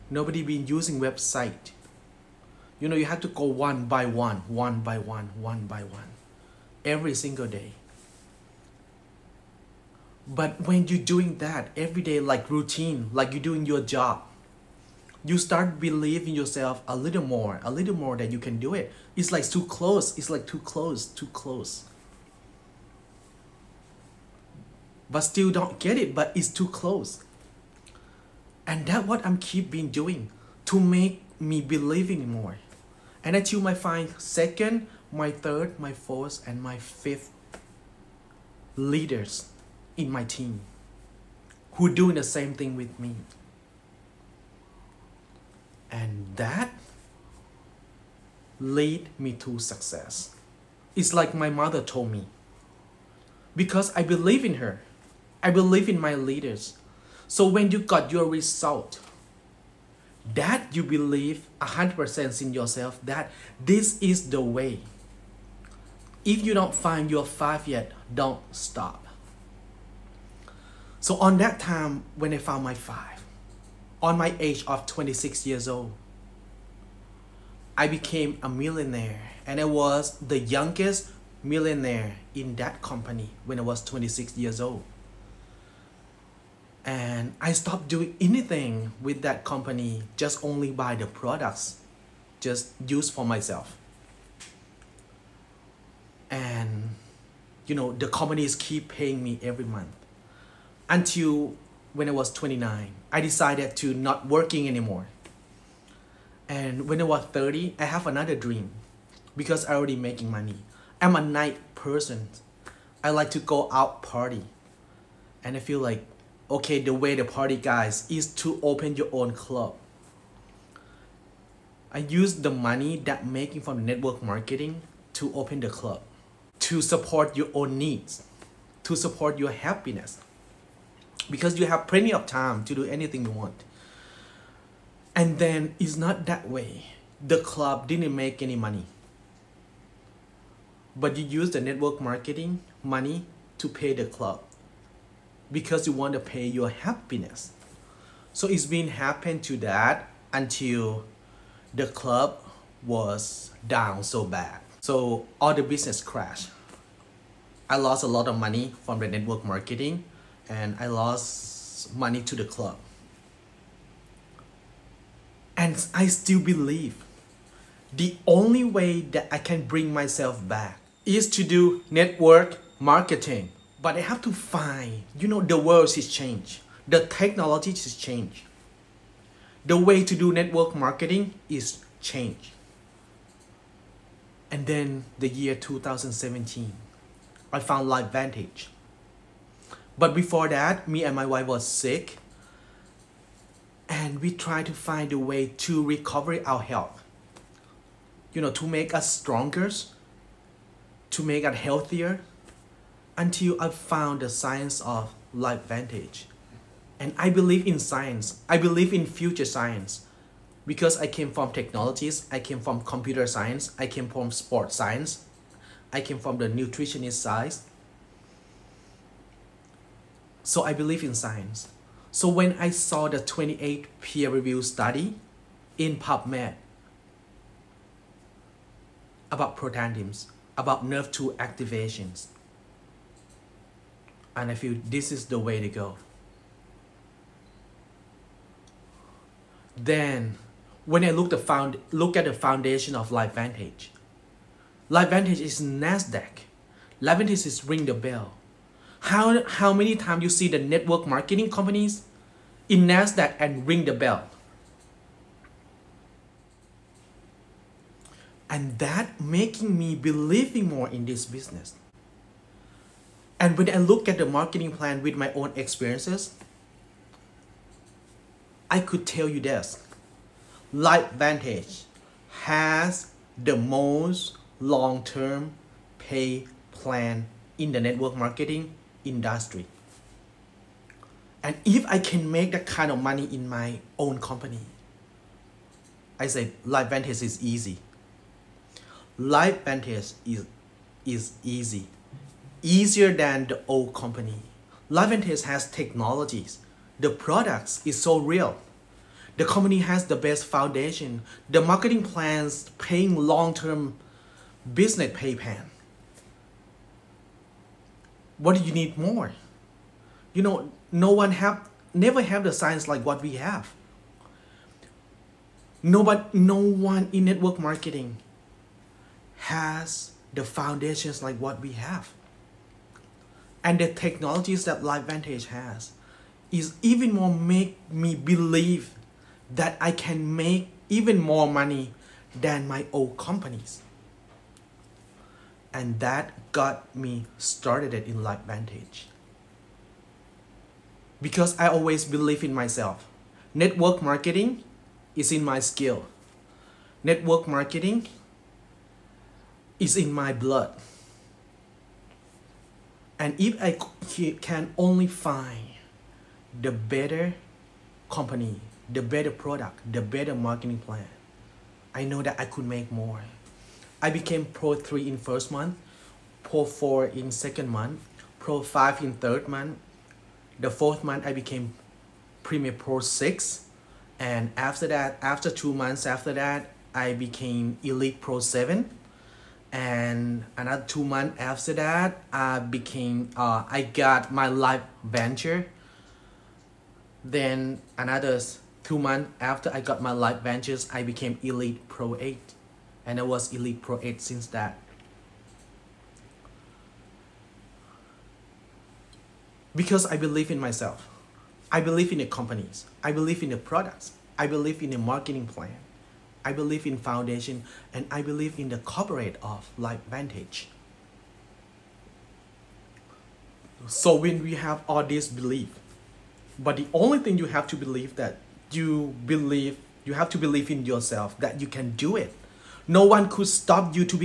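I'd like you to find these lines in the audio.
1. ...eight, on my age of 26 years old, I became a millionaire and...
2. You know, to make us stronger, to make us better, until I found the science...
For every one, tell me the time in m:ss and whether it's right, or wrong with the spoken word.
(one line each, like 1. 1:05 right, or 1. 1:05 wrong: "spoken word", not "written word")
1. 1:12 wrong: "five", not "eight"
2. 3:18 wrong: "healthier", not "better".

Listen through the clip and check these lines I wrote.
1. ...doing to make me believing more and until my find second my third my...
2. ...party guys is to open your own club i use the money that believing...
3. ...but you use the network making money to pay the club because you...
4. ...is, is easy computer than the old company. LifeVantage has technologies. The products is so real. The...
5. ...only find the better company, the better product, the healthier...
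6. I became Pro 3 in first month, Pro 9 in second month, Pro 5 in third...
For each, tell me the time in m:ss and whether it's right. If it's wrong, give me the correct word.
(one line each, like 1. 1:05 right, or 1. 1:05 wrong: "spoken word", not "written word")
1. 0:29 right
2. 1:57 wrong: "making", not "believing"
3. 2:20 wrong: "marketing", not "making"
4. 4:50 wrong: "easier", not "computer"
5. 5:54 wrong: "better", not "healthier"
6. 6:04 wrong: "4", not "9".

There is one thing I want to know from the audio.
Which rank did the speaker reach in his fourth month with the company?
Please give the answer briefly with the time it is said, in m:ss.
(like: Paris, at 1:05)
Premier Pro 6, at 6:12.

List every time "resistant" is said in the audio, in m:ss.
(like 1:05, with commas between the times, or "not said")
not said.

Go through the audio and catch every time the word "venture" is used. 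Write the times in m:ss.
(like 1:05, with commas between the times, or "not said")
6:25, 6:30.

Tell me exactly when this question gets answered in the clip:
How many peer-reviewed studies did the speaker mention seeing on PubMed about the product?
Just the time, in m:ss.
3:43.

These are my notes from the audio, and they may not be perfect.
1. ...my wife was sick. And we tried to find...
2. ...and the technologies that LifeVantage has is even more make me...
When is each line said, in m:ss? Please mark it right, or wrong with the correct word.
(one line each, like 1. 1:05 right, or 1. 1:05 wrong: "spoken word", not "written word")
1. 3:11 right
2. 5:23 right.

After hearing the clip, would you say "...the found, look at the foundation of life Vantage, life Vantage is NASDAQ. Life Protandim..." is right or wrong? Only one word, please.
wrong.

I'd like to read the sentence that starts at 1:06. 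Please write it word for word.
If you don't find your five yet, don't stop.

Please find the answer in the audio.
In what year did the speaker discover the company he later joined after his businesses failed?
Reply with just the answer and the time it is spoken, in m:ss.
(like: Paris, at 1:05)
2017, at 3:05.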